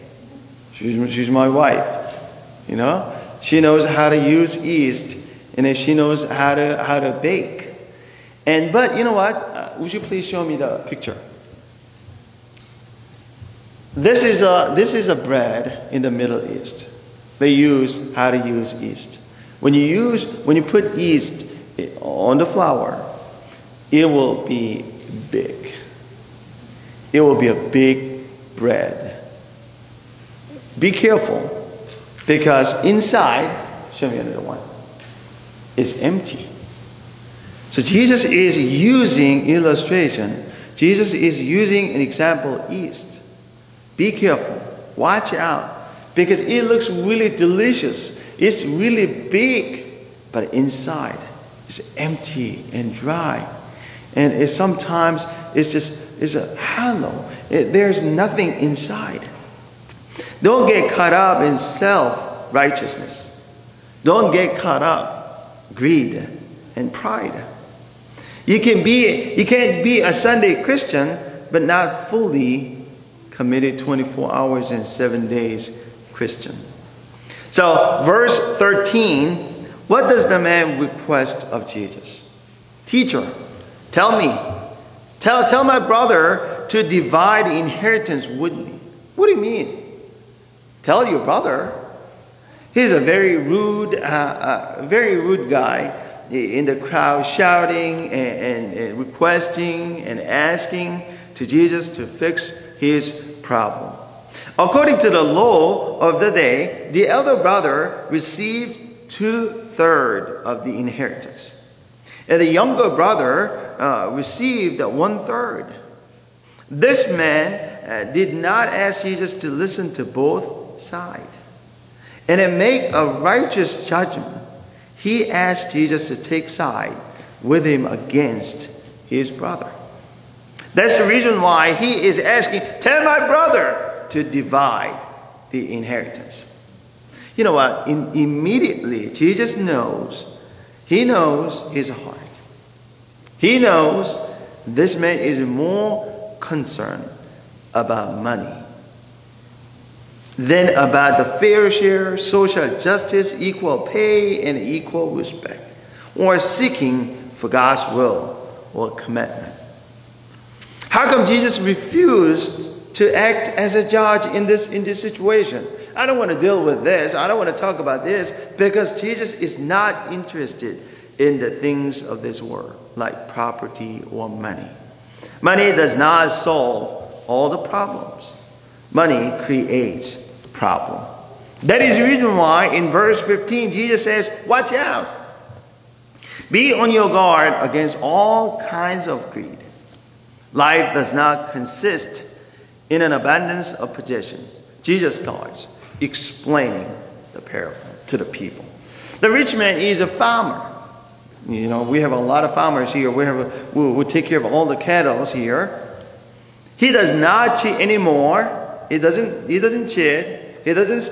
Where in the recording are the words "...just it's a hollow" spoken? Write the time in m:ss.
0:55.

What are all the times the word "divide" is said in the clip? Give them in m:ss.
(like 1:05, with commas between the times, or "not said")
1:26, 2:14.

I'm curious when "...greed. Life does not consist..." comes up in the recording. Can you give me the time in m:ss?
3:09.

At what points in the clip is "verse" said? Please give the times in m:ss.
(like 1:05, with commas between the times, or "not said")
1:18, 3:02.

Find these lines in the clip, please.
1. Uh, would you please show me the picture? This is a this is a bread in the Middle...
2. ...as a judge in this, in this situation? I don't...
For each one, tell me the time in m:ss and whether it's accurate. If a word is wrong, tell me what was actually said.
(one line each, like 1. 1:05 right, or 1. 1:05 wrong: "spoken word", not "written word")
1. 0:09 right
2. 2:43 right.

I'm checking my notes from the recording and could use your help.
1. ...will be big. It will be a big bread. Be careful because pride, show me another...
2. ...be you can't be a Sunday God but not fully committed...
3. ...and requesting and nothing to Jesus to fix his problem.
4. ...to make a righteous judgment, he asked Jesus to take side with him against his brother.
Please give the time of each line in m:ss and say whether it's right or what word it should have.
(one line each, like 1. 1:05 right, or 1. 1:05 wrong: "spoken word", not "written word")
1. 0:24 wrong: "inside", not "pride"
2. 1:08 wrong: "Christian", not "God"
3. 1:38 wrong: "asking", not "nothing"
4. 2:02 right.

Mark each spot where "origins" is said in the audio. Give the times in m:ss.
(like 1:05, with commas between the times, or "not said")
not said.